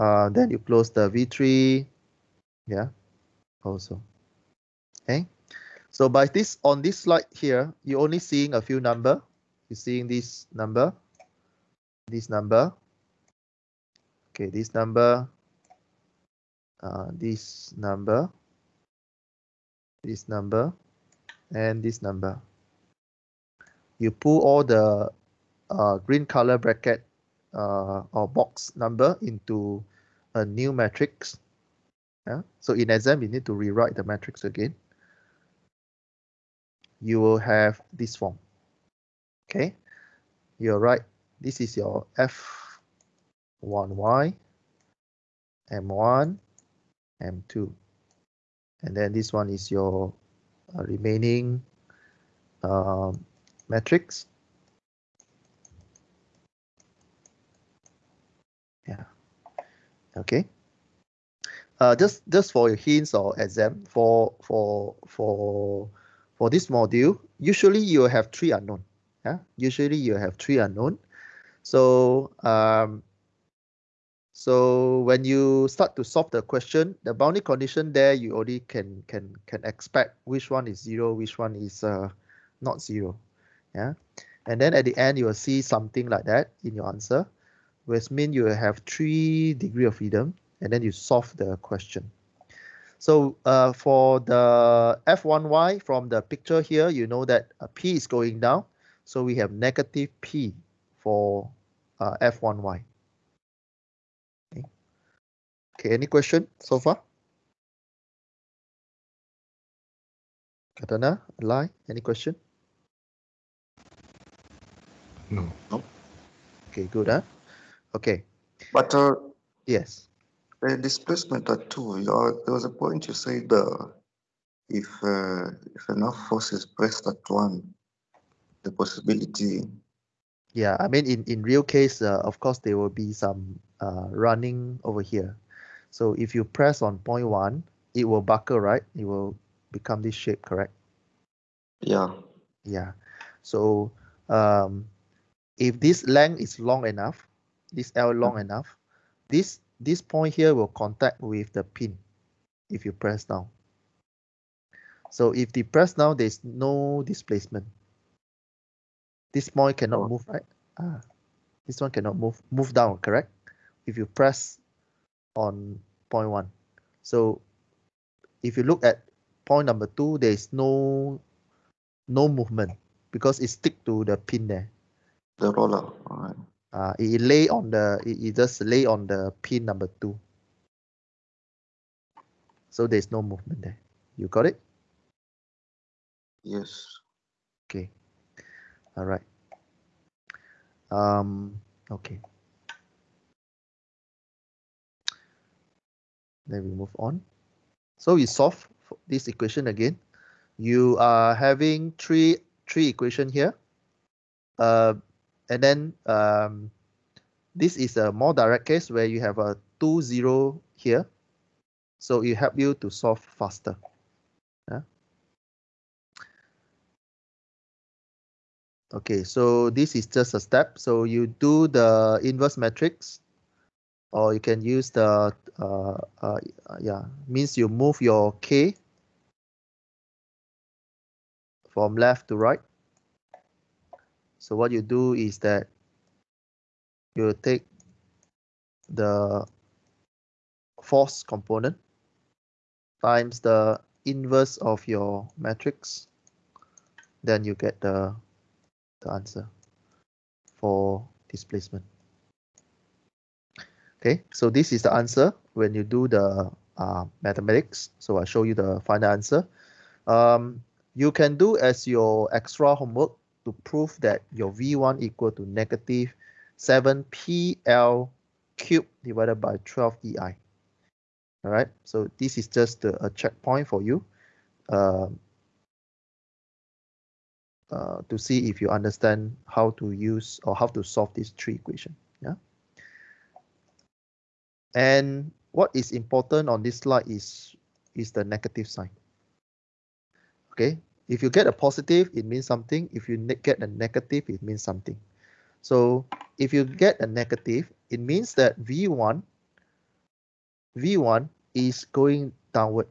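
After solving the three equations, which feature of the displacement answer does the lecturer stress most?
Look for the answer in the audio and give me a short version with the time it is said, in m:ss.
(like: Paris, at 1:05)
the negative sign, at 4:48.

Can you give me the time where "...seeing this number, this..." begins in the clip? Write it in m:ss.
0:09.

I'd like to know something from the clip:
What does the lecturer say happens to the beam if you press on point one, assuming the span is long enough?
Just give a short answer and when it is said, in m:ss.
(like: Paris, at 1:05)
It will buckle, at 2:17.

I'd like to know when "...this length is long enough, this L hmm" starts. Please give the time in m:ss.
2:25.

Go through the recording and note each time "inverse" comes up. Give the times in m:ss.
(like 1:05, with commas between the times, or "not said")
3:42, 4:04.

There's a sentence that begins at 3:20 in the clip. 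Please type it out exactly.
You are having three three equation here.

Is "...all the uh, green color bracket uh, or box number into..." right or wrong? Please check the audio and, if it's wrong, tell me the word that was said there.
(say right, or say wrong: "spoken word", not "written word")
right.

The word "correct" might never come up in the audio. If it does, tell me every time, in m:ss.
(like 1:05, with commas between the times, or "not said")
2:20, 2:42.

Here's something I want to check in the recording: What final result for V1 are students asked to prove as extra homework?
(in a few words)
-7PL³/12EI.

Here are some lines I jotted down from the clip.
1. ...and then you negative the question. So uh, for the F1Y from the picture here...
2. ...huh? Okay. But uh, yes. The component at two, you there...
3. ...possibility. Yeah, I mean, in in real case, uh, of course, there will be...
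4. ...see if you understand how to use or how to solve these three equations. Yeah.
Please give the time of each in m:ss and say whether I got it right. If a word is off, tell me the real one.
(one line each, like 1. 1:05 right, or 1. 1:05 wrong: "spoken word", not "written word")
1. 1:30 wrong: "solve", not "negative"
2. 1:57 wrong: "displacement", not "component"
3. 2:08 right
4. 4:38 right.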